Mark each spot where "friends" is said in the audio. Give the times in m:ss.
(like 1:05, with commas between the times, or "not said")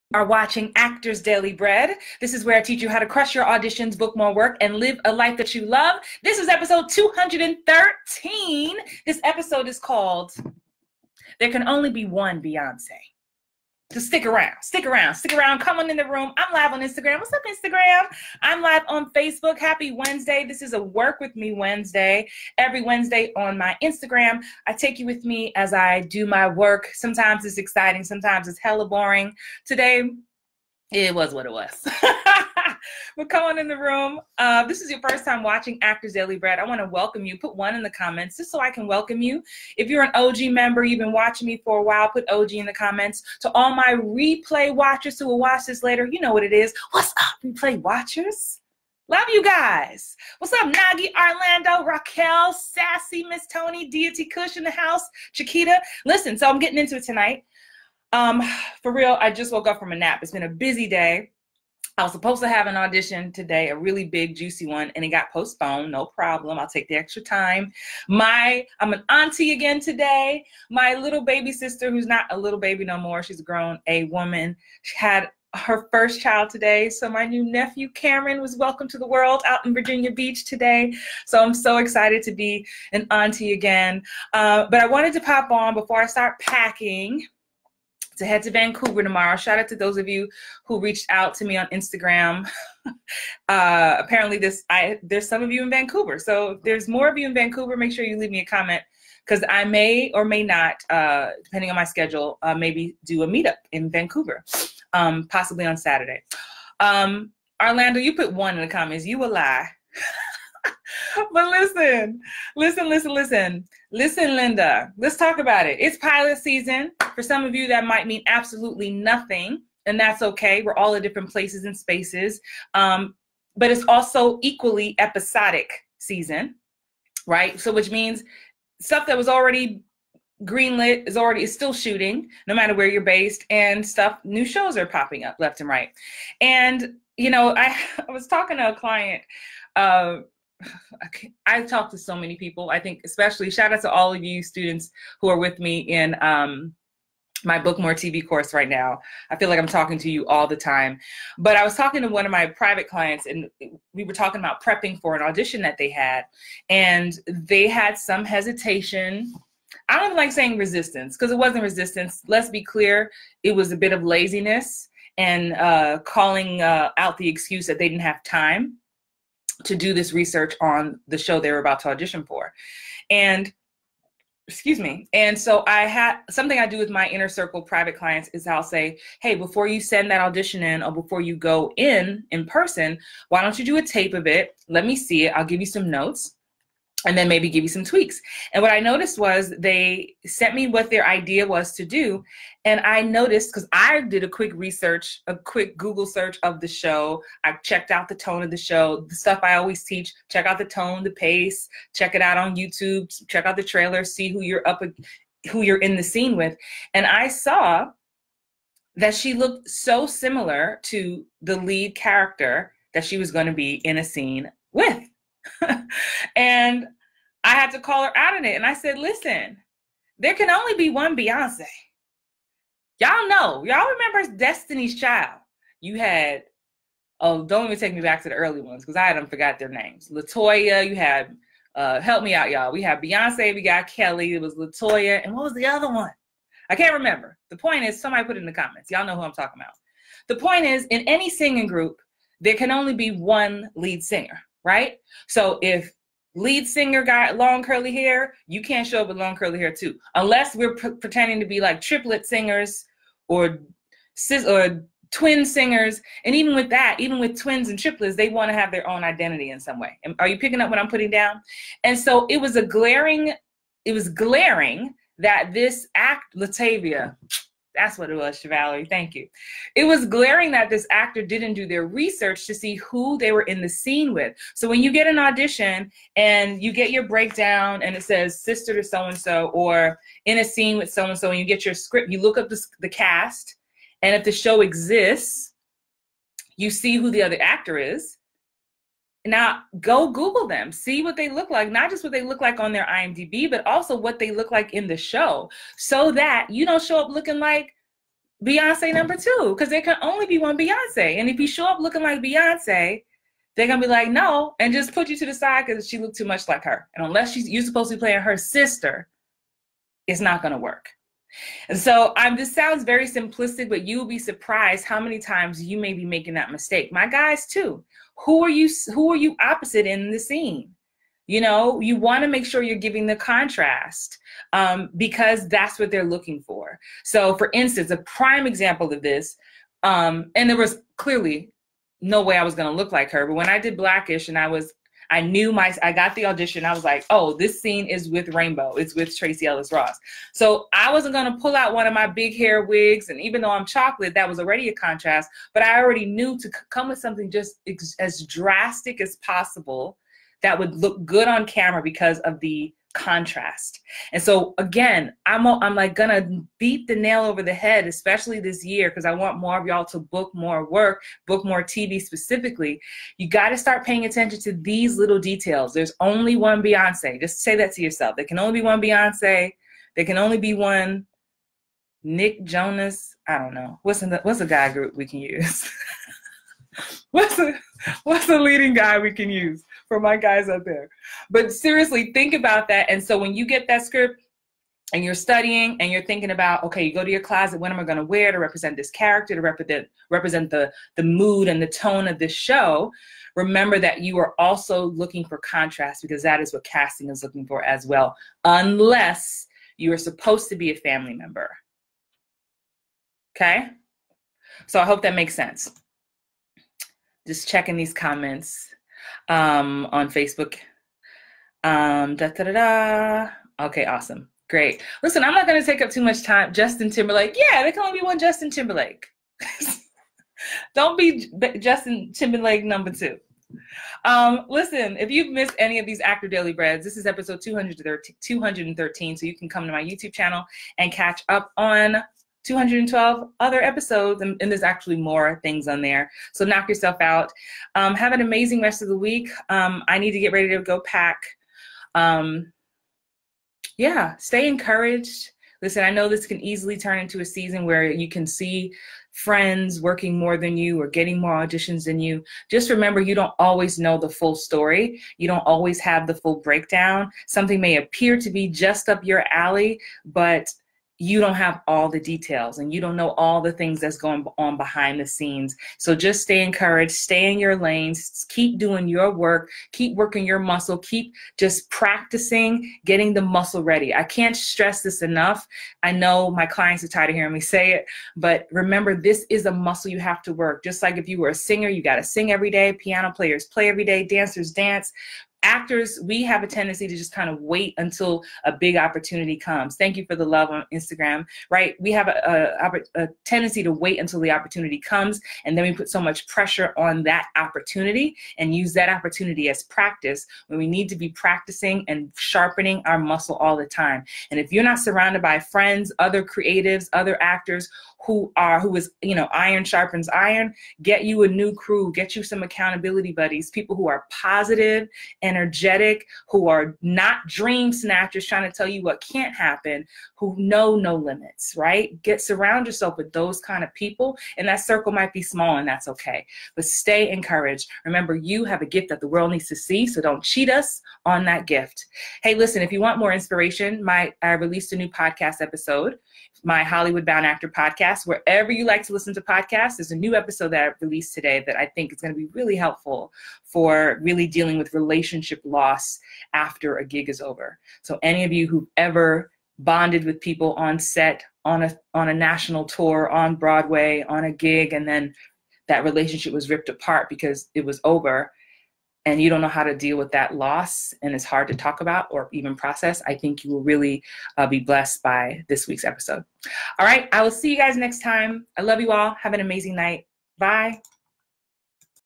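7:29, 8:25.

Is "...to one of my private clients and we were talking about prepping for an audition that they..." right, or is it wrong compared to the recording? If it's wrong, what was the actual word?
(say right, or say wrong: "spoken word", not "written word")
right.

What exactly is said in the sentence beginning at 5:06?
And unless she's, you're supposed to be playing her sister, it's not gonna work.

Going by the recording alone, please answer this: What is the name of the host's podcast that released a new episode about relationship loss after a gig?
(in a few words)
Hollywood Bound Actor.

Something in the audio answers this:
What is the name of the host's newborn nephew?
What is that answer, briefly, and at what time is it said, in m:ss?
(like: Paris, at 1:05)
Cameron, at 1:17.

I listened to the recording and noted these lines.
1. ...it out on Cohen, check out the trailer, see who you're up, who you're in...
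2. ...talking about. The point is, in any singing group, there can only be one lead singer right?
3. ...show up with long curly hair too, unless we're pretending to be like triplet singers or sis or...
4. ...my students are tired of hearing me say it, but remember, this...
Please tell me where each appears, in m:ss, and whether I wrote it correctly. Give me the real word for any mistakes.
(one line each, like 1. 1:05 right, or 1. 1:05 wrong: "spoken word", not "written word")
1. 3:22 wrong: "YouTube", not "Cohen"
2. 3:59 right
3. 4:08 right
4. 7:56 wrong: "clients", not "students".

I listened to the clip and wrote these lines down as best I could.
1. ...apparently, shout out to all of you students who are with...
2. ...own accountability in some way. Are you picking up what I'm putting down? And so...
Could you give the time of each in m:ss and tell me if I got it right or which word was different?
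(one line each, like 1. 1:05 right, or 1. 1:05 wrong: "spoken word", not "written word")
1. 2:23 wrong: "especially", not "apparently"
2. 4:18 wrong: "identity", not "accountability".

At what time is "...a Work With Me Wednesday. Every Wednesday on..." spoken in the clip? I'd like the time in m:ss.
0:20.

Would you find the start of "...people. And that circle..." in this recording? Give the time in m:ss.
8:43.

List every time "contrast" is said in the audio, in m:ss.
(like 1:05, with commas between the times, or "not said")
5:23, 5:44, 5:52, 6:35.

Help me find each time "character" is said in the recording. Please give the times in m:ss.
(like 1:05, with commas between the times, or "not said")
3:31, 6:28.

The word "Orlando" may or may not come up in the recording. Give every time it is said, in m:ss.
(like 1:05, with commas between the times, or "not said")
0:51, 1:47.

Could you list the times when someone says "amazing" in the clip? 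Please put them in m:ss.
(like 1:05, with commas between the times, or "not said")
7:18, 9:29.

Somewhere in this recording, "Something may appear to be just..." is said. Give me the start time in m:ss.
7:37.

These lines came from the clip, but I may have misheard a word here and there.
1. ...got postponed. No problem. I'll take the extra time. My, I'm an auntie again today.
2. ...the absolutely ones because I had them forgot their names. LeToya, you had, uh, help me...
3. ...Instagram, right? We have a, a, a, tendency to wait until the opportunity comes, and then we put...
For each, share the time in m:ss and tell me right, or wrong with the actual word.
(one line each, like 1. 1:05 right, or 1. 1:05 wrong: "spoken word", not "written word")
1. 1:05 right
2. 3:48 wrong: "early", not "absolutely"
3. 8:10 right.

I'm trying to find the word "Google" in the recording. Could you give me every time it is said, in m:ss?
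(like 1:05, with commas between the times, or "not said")
3:15, 4:50.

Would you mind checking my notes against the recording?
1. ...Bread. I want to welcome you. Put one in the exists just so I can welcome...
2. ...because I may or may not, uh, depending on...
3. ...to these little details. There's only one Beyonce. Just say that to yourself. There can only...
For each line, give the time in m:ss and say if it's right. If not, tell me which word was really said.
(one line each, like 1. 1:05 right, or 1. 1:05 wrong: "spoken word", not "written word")
1. 0:36 wrong: "comments", not "exists"
2. 1:39 right
3. 6:04 right.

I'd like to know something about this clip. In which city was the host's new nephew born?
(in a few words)
Virginia Beach.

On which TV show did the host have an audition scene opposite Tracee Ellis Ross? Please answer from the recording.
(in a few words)
Blackish.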